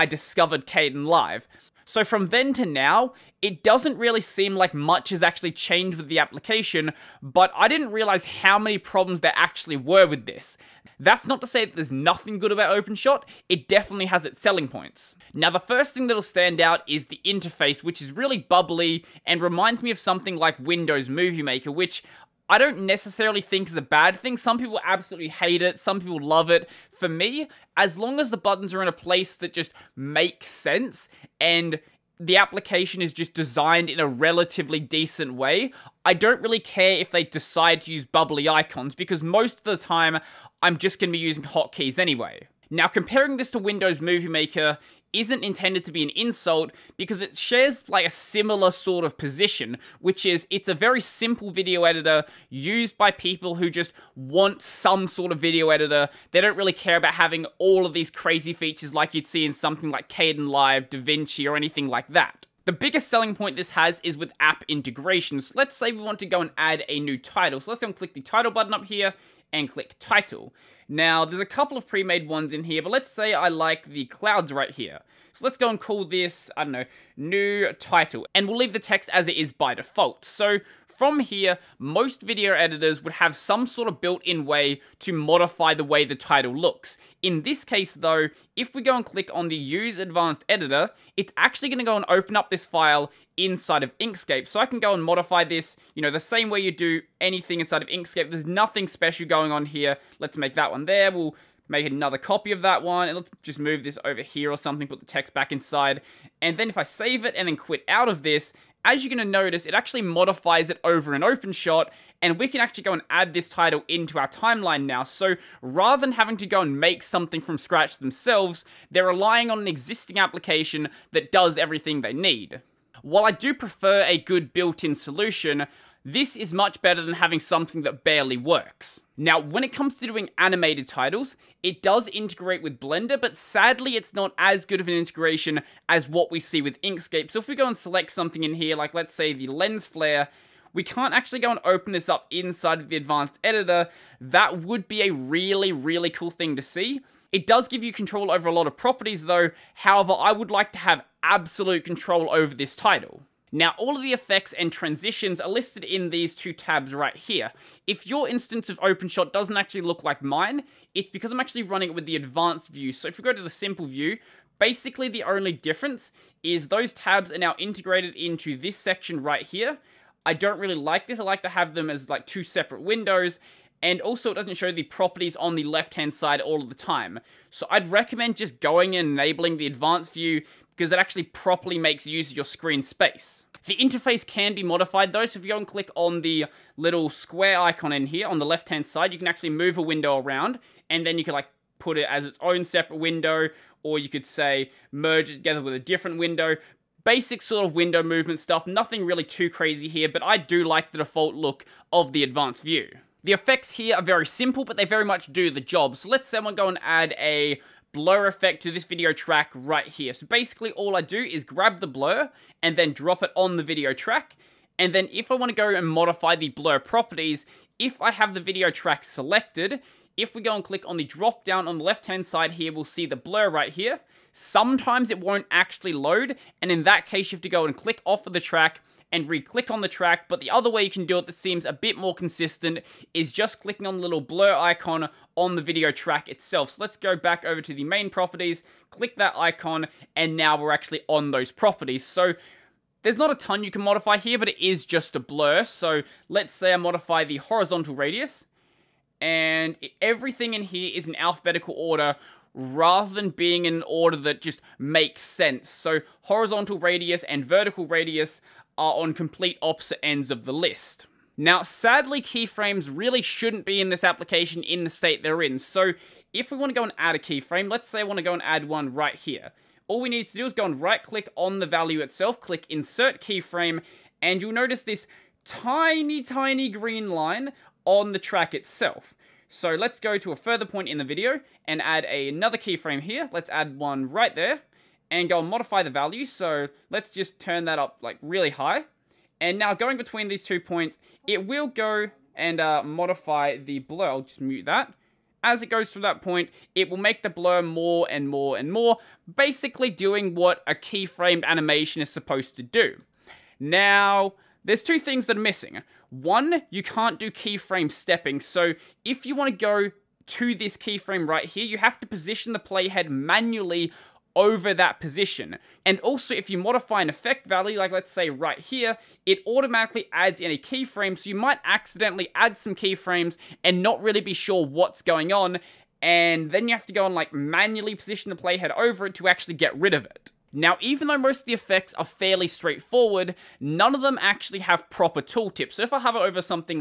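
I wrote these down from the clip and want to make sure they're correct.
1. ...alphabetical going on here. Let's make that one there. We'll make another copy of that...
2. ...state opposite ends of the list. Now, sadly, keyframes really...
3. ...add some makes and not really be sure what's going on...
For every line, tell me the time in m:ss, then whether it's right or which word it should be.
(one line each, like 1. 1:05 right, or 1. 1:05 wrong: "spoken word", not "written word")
1. 1:38 wrong: "special", not "alphabetical"
2. 4:19 wrong: "complete", not "state"
3. 5:22 wrong: "keyframes", not "makes".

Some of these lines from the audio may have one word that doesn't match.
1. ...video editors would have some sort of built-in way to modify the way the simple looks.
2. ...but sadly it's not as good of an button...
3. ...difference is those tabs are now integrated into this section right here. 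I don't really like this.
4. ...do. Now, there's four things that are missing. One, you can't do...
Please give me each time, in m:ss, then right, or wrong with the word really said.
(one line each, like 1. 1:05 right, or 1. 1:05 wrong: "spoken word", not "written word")
1. 1:22 wrong: "title", not "simple"
2. 2:13 wrong: "integration", not "button"
3. 2:45 right
4. 5:02 wrong: "two", not "four".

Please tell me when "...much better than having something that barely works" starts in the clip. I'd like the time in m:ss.
2:06.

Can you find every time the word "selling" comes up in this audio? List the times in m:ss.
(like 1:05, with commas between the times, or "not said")
0:14, 1:03.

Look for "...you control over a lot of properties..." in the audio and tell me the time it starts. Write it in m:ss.
2:27.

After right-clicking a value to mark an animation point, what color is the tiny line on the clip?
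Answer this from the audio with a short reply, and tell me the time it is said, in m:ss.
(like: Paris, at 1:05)
green, at 4:36.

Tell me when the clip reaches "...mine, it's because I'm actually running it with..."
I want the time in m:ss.
2:40.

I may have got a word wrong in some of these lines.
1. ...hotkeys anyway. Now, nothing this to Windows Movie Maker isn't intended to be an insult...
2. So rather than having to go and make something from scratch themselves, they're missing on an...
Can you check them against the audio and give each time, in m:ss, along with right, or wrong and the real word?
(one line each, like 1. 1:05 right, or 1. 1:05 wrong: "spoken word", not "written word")
1. 0:41 wrong: "comparing", not "nothing"
2. 1:55 wrong: "relying", not "missing".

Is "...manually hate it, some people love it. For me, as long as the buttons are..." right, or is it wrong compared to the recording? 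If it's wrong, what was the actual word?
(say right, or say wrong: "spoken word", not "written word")
wrong: "absolutely", not "manually".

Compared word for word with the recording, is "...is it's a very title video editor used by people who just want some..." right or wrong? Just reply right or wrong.
wrong.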